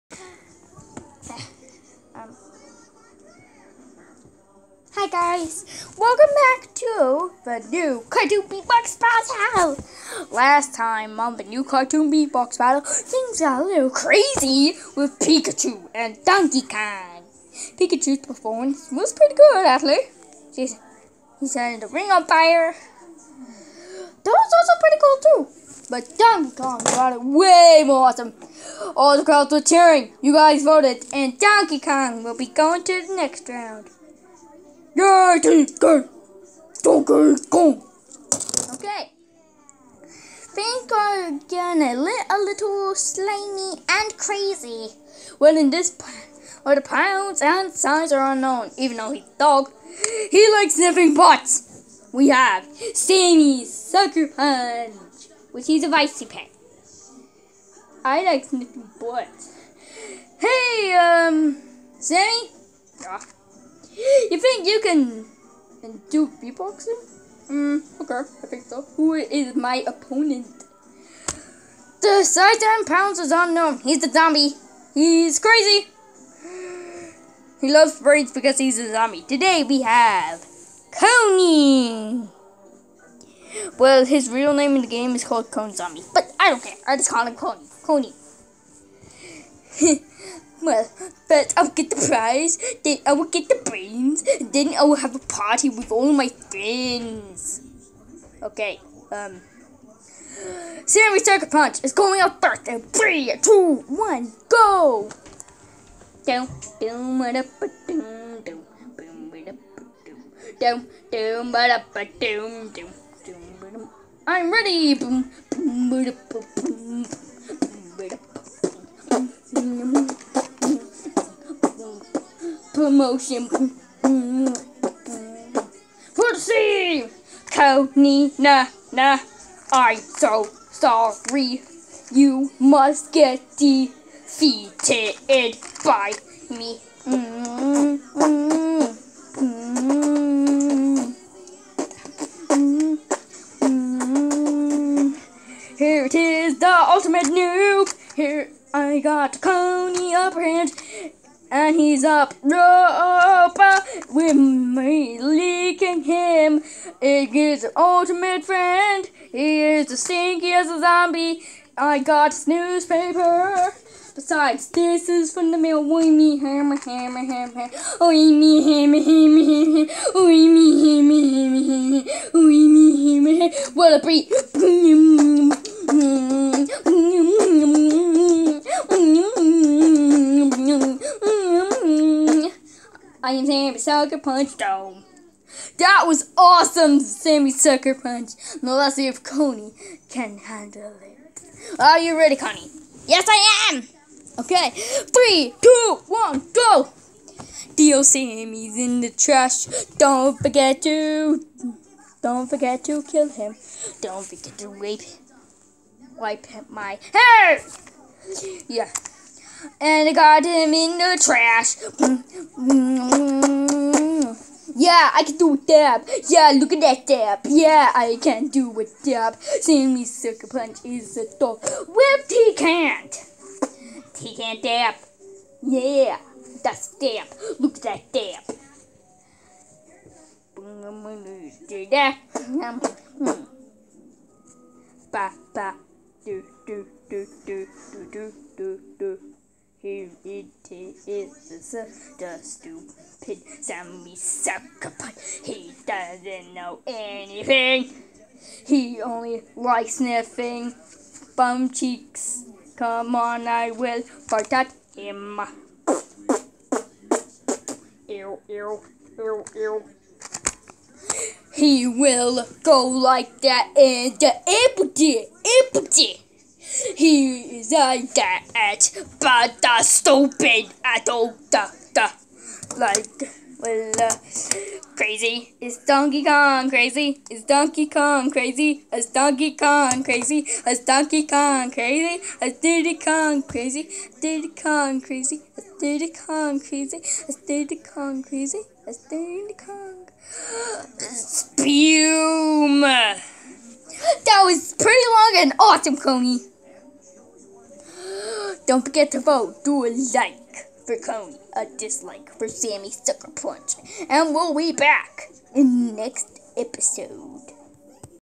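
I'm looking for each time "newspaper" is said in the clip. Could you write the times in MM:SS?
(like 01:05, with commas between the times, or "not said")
02:42.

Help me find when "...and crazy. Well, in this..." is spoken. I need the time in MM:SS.
00:43.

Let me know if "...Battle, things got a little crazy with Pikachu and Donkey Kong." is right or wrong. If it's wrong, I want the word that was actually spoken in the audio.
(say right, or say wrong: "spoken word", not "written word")
right.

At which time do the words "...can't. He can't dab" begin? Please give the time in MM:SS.
03:42.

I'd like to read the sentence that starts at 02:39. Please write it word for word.
He is as stinky as a zombie.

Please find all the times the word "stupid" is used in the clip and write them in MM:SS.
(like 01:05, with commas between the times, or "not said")
04:02, 04:29.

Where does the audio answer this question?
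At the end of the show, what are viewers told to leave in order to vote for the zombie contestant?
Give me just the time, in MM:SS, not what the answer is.
04:59.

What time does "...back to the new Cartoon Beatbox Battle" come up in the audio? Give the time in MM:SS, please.
00:06.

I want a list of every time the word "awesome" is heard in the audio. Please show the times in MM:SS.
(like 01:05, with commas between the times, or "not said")
00:28, 03:06, 04:55.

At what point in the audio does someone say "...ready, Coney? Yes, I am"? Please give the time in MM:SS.
03:12.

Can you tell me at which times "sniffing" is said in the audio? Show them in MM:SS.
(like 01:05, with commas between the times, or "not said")
00:50, 00:58, 04:09.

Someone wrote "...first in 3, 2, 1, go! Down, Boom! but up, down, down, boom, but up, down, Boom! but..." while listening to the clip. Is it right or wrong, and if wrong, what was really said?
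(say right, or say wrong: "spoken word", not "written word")
right.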